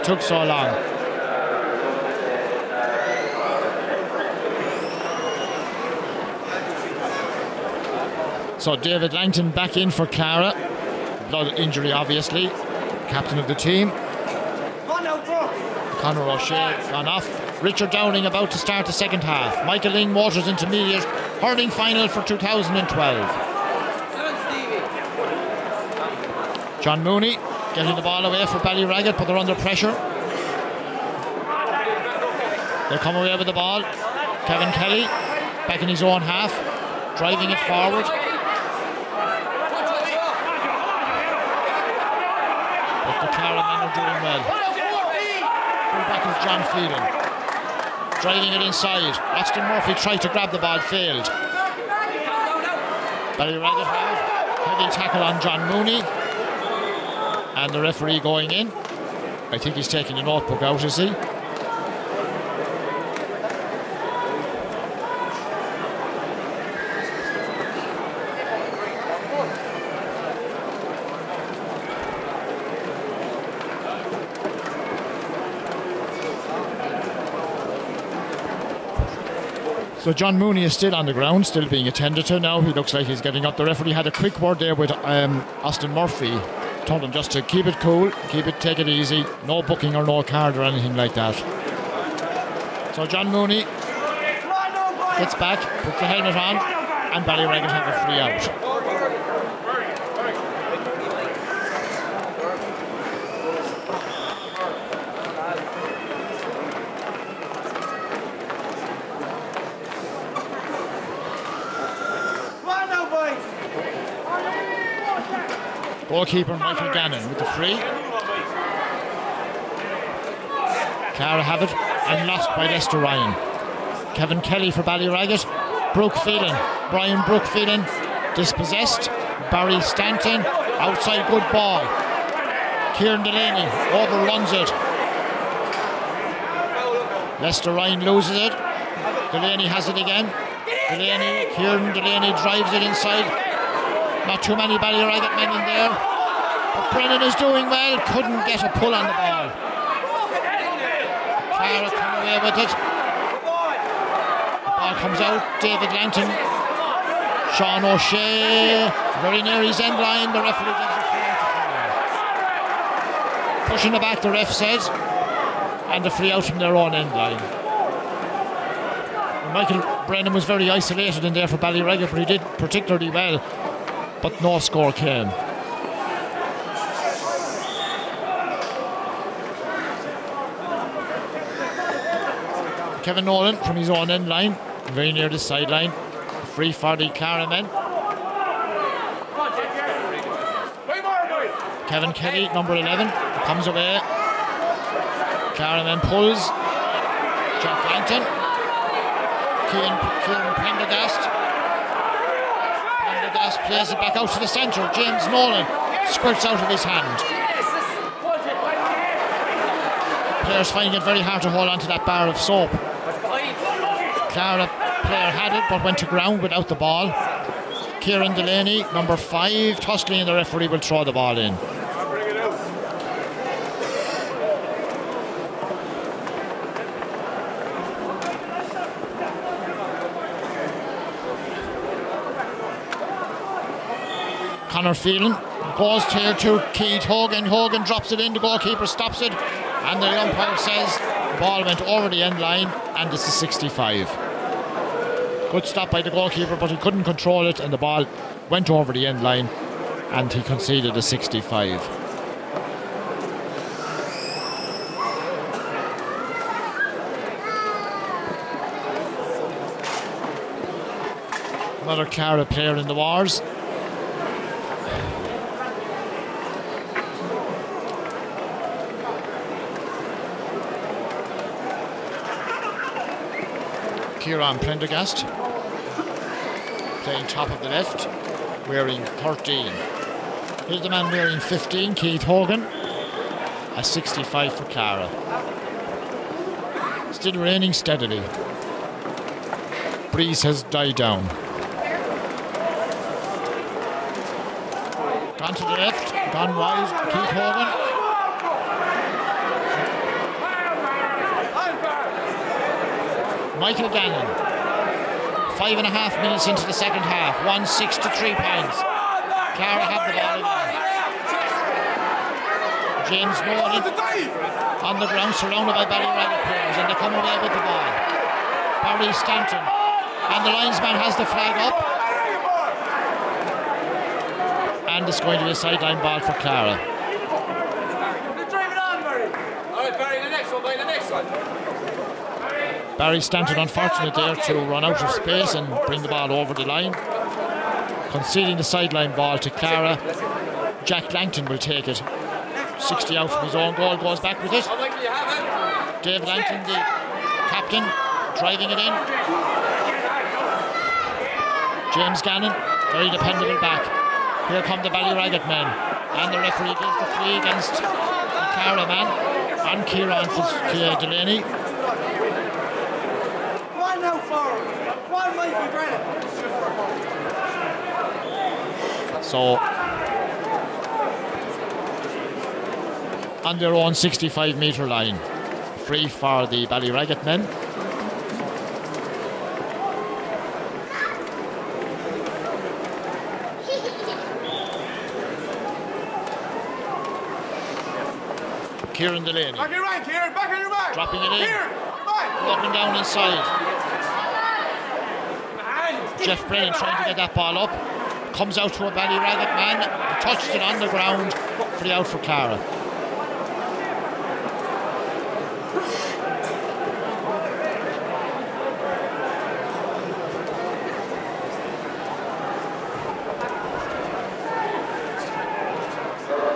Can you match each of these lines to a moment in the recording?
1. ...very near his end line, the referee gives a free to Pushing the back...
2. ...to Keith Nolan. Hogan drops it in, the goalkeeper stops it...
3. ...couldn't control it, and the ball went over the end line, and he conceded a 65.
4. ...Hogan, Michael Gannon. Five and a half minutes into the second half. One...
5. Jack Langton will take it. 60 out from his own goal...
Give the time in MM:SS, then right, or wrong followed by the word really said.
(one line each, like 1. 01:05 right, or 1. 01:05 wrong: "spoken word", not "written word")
1. 02:39 right
2. 03:56 wrong: "Hogan", not "Nolan"
3. 04:06 right
4. 04:57 right
5. 05:40 right.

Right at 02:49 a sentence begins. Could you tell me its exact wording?
Michael Brennan was very isolated in there for Ballyragget, but he did particularly well.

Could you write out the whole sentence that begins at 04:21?
Another Clara player in the wars.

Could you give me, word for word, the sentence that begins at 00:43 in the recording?
But the Clara men are doing well.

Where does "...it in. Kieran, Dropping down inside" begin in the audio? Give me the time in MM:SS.
06:31.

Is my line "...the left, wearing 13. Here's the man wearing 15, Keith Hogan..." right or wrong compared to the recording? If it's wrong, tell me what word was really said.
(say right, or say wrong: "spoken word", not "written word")
right.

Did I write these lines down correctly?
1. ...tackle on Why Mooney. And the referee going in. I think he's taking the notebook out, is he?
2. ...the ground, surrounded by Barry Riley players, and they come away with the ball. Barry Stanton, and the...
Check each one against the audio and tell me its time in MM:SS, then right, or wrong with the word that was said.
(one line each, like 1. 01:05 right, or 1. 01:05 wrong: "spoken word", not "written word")
1. 00:54 wrong: "John", not "Why"
2. 05:14 right.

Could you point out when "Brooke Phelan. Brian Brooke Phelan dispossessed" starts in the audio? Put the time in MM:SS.
02:05.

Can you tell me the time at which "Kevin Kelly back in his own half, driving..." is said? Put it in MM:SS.
00:34.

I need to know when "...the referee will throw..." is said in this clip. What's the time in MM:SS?
03:40.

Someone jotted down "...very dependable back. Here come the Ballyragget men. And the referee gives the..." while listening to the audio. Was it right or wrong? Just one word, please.
right.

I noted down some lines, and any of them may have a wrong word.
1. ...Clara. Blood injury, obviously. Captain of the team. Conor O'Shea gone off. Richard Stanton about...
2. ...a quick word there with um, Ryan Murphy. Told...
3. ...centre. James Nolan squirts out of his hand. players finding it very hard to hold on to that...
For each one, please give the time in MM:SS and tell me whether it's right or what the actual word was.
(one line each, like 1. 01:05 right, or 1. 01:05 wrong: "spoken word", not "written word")
1. 00:10 wrong: "Downing", not "Stanton"
2. 01:24 wrong: "Austin", not "Ryan"
3. 03:24 right.